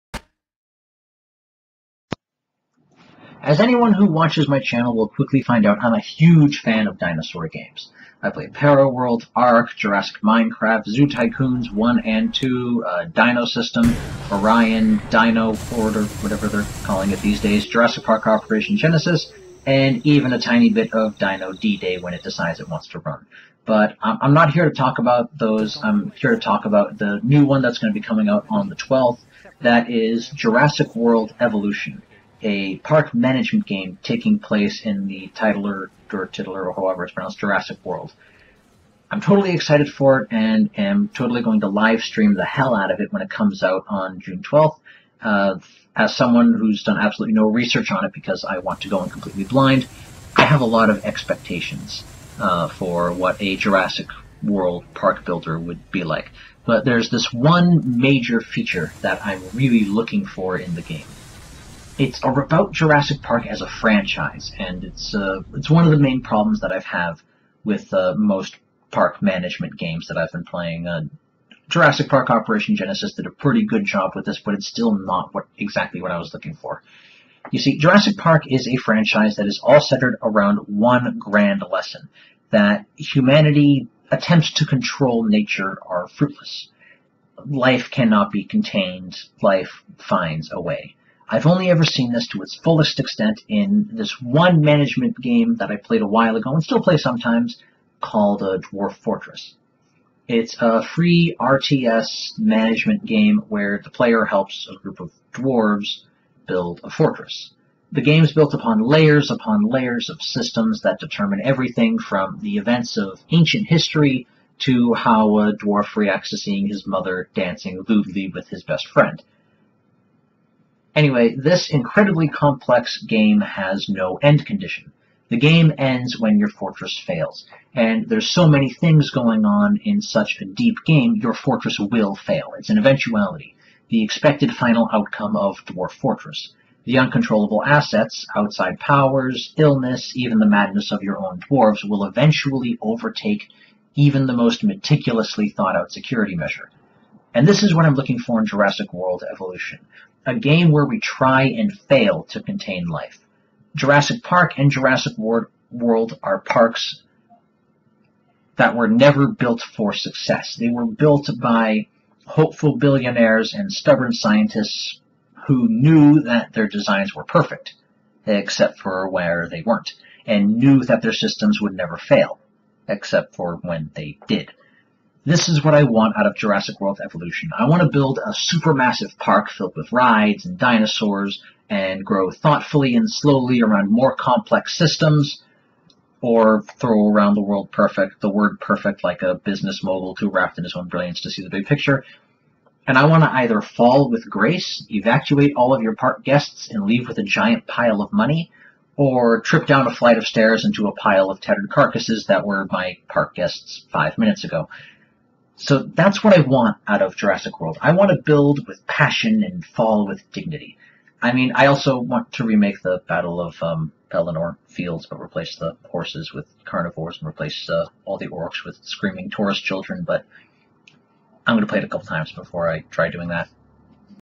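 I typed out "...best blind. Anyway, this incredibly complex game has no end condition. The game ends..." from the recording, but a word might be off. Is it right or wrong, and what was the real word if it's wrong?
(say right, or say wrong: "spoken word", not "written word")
wrong: "friend", not "blind".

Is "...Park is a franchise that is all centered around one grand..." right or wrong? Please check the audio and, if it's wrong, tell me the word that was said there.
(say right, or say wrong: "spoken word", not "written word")
right.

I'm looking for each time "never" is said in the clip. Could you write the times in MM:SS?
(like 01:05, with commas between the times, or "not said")
02:38, 02:51.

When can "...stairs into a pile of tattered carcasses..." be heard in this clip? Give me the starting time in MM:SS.
03:20.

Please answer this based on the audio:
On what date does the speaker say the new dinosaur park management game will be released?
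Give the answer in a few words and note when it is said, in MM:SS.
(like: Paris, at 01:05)
June 12th, at 00:44.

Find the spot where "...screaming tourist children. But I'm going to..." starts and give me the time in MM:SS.
03:38.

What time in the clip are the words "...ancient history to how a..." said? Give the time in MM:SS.
01:53.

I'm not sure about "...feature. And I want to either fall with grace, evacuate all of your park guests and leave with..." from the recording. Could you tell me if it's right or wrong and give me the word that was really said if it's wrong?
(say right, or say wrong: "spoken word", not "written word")
wrong: "picture", not "feature".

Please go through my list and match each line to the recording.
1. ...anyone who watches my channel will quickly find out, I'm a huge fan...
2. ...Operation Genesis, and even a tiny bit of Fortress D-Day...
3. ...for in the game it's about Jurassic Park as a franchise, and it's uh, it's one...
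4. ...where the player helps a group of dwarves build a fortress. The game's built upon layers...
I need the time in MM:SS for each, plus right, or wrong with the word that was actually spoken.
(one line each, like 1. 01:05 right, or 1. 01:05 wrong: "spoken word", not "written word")
1. 00:03 right
2. 00:18 wrong: "Dino", not "Fortress"
3. 01:00 right
4. 01:43 right.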